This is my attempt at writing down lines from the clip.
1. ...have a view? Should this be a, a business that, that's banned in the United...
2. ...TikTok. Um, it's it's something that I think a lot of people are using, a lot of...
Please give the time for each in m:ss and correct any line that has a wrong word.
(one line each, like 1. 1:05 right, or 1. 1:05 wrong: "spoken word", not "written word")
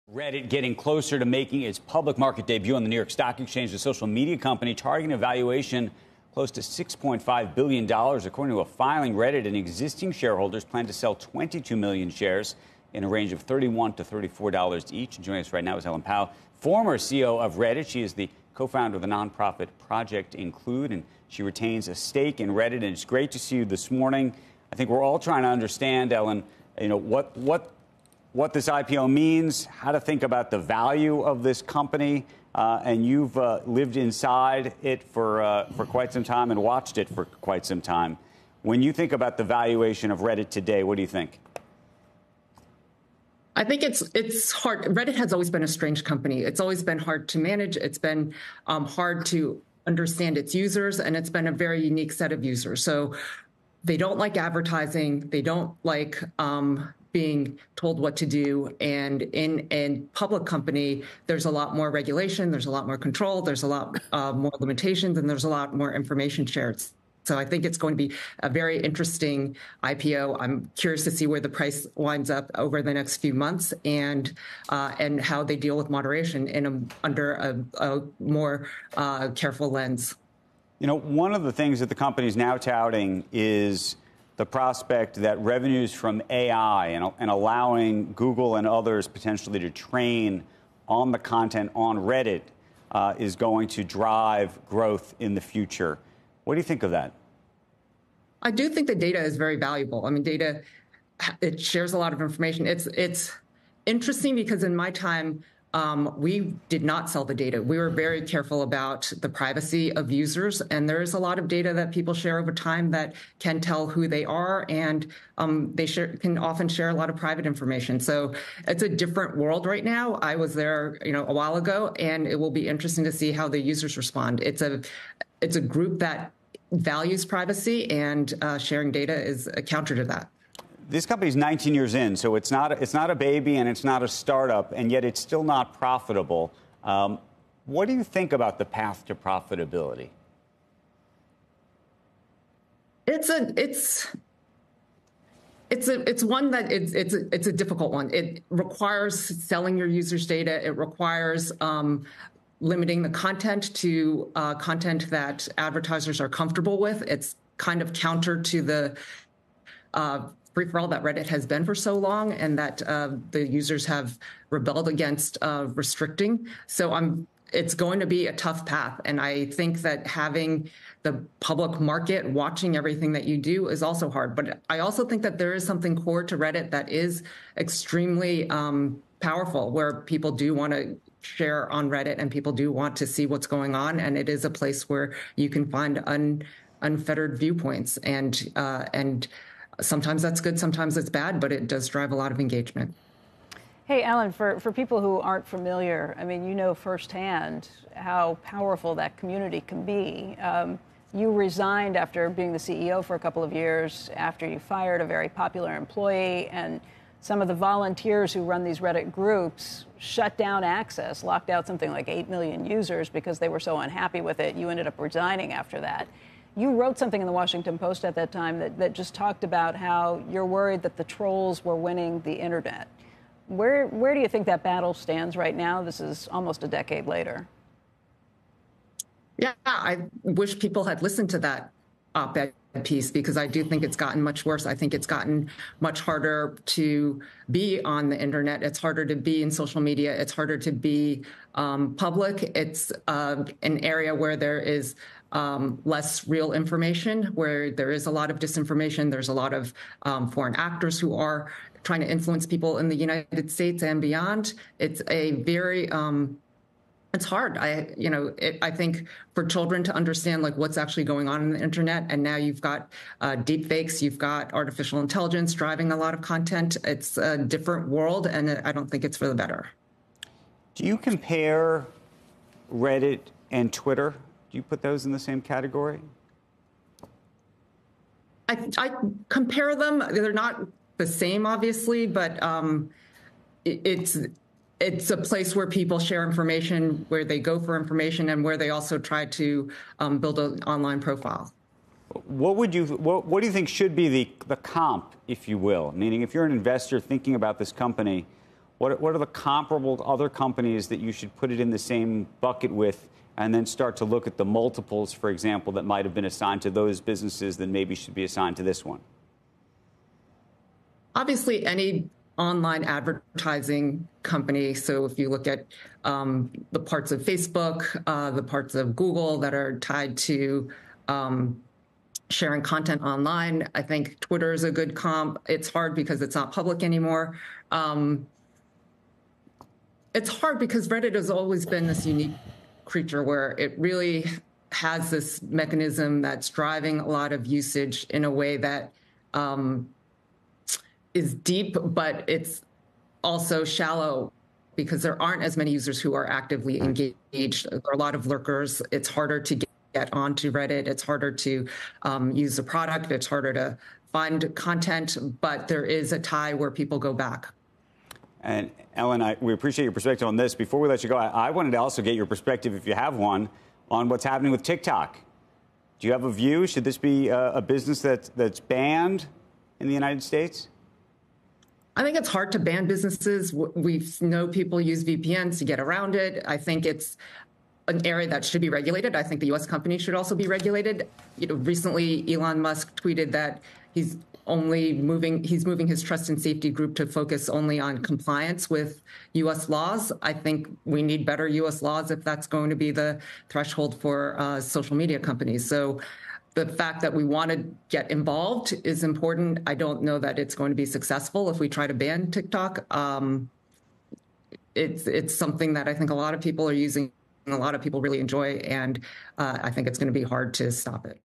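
1. 6:06 right
2. 6:42 right.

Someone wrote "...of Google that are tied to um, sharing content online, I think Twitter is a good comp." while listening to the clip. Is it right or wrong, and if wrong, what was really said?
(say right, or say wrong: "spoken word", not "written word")
right.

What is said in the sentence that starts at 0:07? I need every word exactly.
According to a filing, Reddit and existing shareholders plan to sell 22 million shares in a range of $31 to $34 each.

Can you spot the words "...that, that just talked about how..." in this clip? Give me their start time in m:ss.
3:38.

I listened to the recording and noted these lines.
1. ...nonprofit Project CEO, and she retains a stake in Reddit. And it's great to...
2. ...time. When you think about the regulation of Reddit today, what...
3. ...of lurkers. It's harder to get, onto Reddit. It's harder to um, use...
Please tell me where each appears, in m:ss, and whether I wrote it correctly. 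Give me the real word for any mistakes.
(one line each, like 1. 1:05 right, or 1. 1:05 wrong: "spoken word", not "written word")
1. 0:19 wrong: "Include", not "CEO"
2. 0:37 wrong: "valuation", not "regulation"
3. 5:48 right.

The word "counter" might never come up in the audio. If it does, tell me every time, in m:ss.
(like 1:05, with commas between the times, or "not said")
2:09, 2:37.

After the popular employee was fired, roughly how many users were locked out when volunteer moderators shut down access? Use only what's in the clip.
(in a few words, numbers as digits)
8 million.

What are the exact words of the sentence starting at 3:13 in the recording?
Hey, Ellen, for, for people who aren't familiar, I mean, you know firsthand how powerful that community can be.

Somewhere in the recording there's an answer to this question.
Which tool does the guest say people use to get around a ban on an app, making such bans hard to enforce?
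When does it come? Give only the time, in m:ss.
6:15.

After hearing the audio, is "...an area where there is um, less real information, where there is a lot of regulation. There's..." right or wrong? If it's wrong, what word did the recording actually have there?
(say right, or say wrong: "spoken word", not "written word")
wrong: "disinformation", not "regulation".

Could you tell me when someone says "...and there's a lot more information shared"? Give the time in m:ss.
1:05.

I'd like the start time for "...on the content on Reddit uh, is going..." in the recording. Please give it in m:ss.
1:30.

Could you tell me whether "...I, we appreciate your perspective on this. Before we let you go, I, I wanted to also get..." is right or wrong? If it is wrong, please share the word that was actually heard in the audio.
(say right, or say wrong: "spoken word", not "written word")
right.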